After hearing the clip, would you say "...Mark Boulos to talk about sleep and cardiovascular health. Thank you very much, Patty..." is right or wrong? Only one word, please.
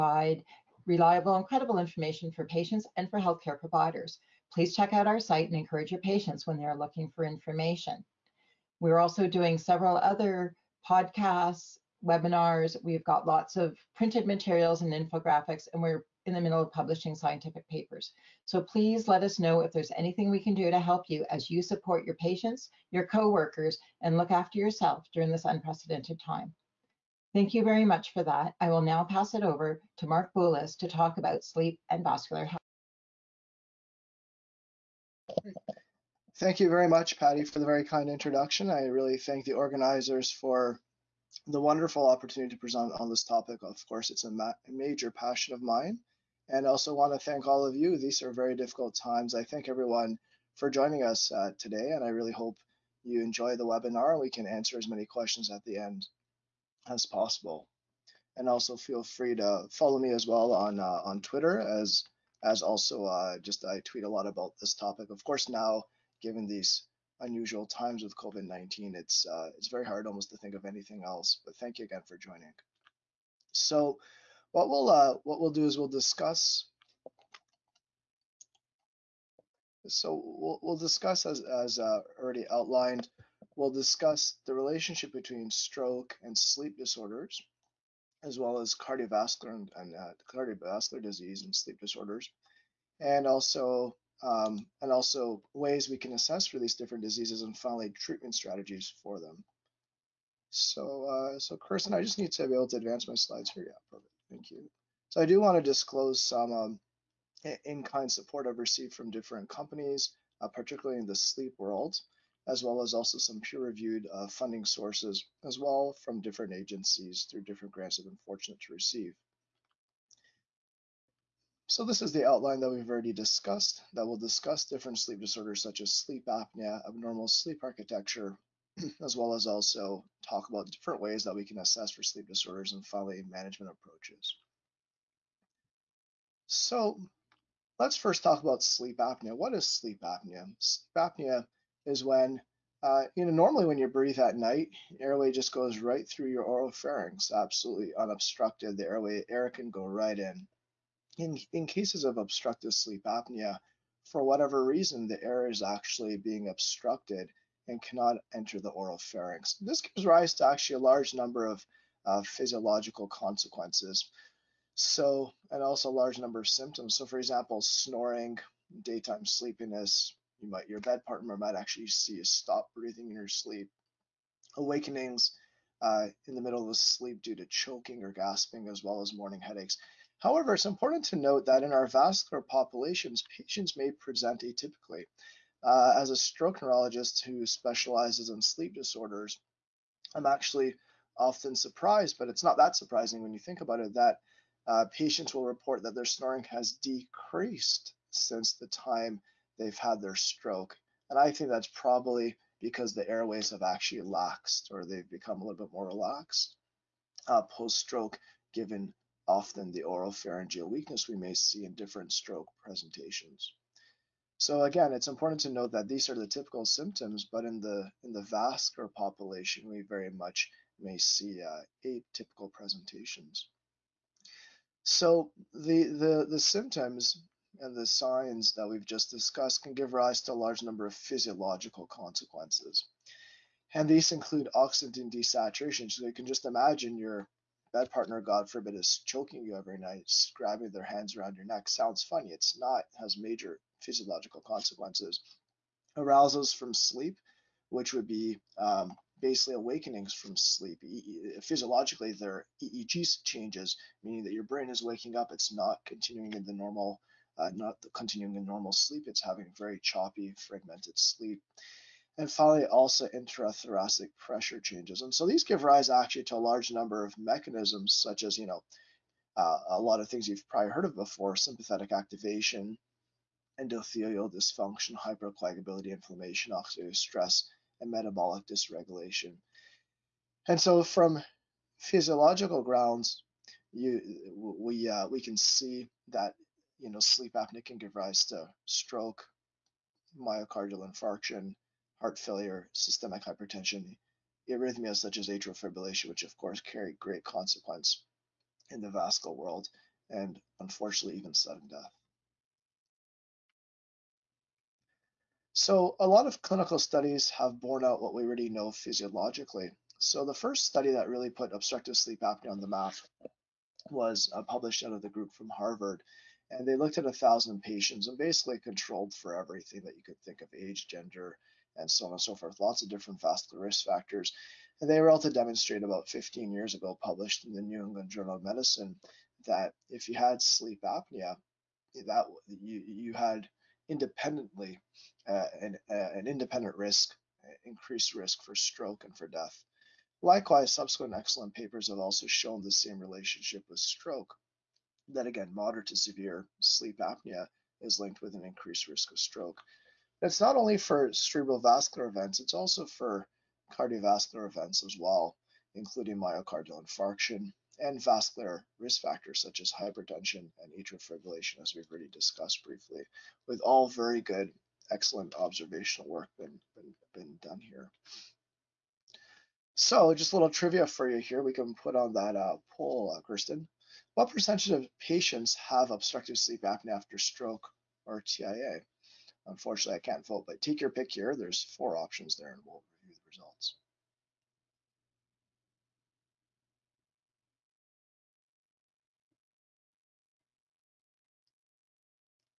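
wrong.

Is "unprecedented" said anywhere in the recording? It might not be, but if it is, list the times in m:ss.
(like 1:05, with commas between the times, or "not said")
0:25.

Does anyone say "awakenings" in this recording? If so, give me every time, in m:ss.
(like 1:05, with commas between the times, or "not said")
2:54, 4:09.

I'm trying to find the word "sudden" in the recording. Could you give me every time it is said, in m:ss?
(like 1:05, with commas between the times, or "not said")
5:01.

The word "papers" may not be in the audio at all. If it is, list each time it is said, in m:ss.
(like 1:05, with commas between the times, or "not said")
0:17, 5:41.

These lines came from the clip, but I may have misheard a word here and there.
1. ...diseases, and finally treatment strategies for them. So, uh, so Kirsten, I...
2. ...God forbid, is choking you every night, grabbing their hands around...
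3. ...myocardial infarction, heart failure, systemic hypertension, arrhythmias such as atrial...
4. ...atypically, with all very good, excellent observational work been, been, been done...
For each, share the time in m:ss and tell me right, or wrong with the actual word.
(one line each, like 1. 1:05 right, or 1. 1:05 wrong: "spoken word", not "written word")
1. 1:37 right
2. 3:58 right
3. 4:50 right
4. 6:02 wrong: "briefly", not "atypically".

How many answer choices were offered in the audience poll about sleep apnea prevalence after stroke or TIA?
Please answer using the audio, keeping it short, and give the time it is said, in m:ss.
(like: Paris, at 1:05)
4, at 6:21.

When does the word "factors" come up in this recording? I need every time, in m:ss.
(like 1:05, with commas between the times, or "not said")
5:23, 5:59.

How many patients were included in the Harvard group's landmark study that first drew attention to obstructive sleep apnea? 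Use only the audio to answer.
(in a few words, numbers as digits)
1000.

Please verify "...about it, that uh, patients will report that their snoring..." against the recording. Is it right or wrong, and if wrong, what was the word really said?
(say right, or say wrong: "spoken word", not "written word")
right.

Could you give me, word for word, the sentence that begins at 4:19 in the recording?
It's having very choppy, fragmented sleep.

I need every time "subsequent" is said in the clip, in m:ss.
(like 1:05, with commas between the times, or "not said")
5:40.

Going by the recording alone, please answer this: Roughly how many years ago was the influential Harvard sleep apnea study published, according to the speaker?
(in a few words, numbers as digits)
15.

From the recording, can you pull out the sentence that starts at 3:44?
So the, the, the symptoms and the signs that we've just discussed can give rise to a large number of physiological consequences.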